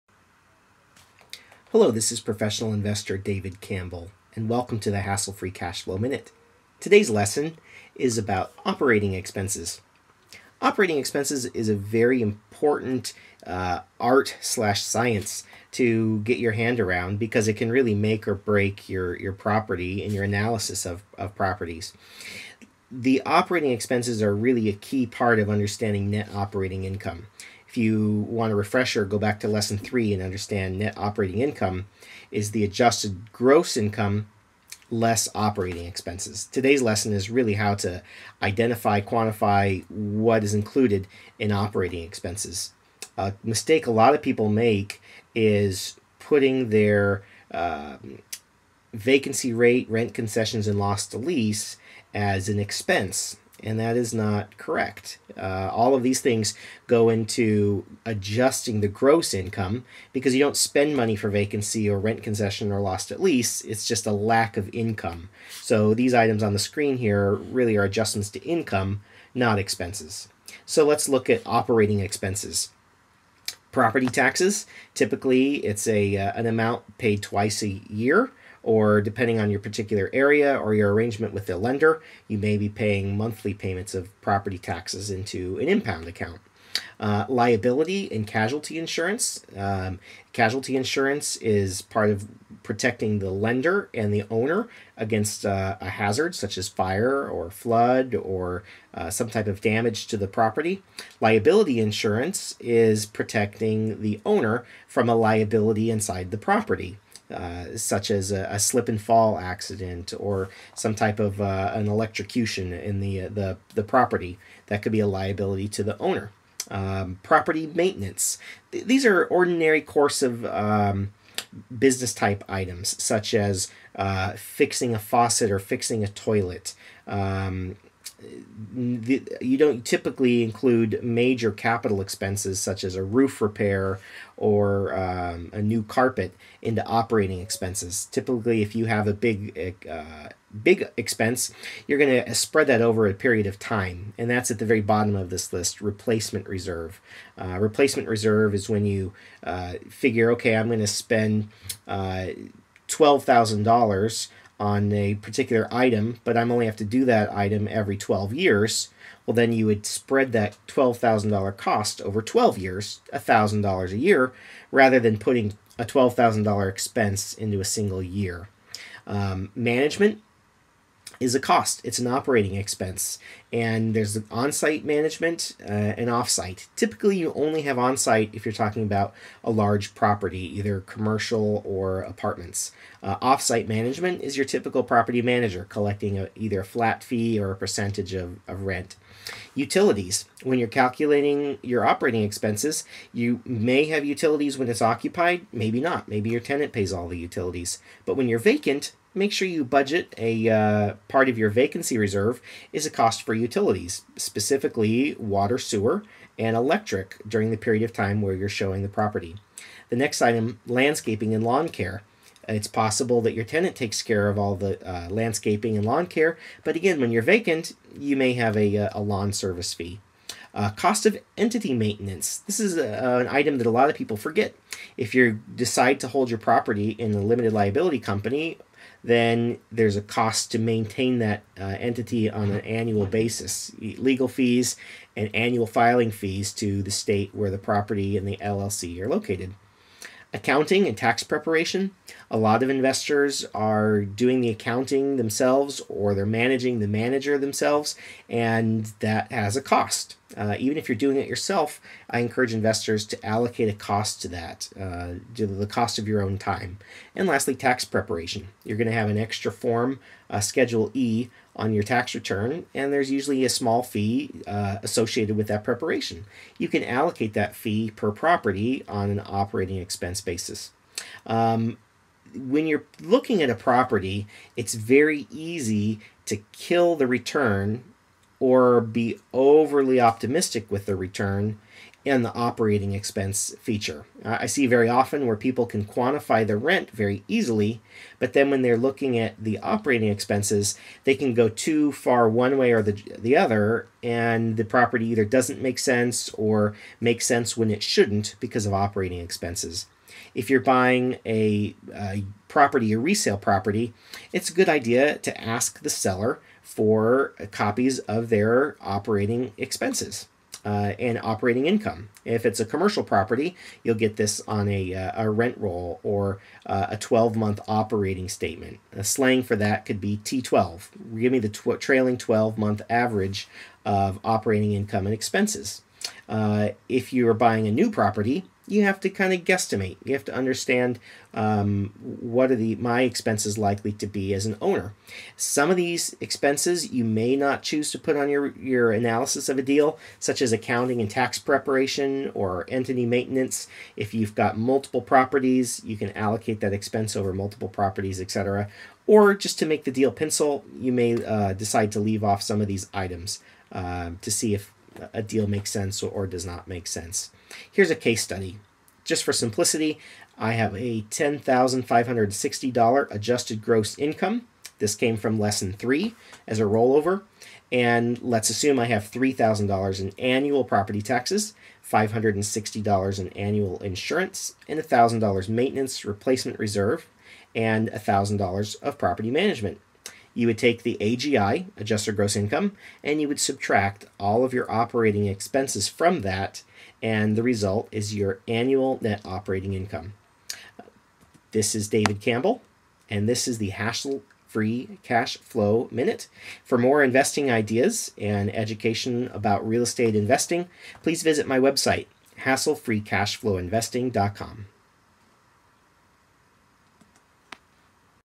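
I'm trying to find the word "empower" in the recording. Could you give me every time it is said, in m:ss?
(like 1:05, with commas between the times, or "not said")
not said.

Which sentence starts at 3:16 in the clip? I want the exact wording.
Maybe your tenant pays all the utilities.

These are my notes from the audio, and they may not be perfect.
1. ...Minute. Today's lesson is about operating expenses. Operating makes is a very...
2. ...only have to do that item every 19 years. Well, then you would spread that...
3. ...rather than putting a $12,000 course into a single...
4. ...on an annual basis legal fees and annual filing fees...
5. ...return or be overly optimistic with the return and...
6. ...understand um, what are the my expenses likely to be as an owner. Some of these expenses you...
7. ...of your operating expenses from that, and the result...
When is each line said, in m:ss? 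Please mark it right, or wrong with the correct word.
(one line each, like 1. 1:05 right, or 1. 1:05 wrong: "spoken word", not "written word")
1. 0:05 wrong: "expenses", not "makes"
2. 2:36 wrong: "12", not "19"
3. 2:44 wrong: "expense", not "course"
4. 3:52 right
5. 4:37 right
6. 5:30 right
7. 6:24 right.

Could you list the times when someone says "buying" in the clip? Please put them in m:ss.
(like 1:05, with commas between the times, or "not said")
5:00, 5:27.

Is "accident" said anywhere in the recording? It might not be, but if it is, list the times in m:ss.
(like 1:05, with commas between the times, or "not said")
1:49.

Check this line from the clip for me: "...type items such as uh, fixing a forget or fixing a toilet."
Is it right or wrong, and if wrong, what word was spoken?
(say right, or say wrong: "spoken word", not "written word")
wrong: "faucet", not "forget".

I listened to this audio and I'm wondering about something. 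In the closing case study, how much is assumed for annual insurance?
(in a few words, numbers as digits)
$560.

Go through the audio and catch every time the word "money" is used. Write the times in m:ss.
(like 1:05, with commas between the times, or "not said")
1:00.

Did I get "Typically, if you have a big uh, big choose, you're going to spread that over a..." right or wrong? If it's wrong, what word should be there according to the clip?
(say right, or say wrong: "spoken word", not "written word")
wrong: "expense", not "choose".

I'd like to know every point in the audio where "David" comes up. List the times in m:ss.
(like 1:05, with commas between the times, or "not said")
0:03, 6:31.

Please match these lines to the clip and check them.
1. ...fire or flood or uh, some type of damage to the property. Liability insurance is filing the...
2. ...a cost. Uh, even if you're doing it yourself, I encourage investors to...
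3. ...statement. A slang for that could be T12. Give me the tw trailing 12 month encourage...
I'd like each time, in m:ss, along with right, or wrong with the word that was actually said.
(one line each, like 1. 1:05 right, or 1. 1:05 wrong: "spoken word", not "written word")
1. 1:36 wrong: "protecting", not "filing"
2. 4:09 right
3. 5:18 wrong: "average", not "encourage".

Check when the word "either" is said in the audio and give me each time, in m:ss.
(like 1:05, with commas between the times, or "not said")
3:00, 3:06, 4:55.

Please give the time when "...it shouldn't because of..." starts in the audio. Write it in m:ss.
4:57.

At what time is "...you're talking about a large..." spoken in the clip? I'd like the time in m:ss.
2:58.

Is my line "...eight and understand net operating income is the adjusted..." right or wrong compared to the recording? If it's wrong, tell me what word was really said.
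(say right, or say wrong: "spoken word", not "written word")
wrong: "three", not "eight".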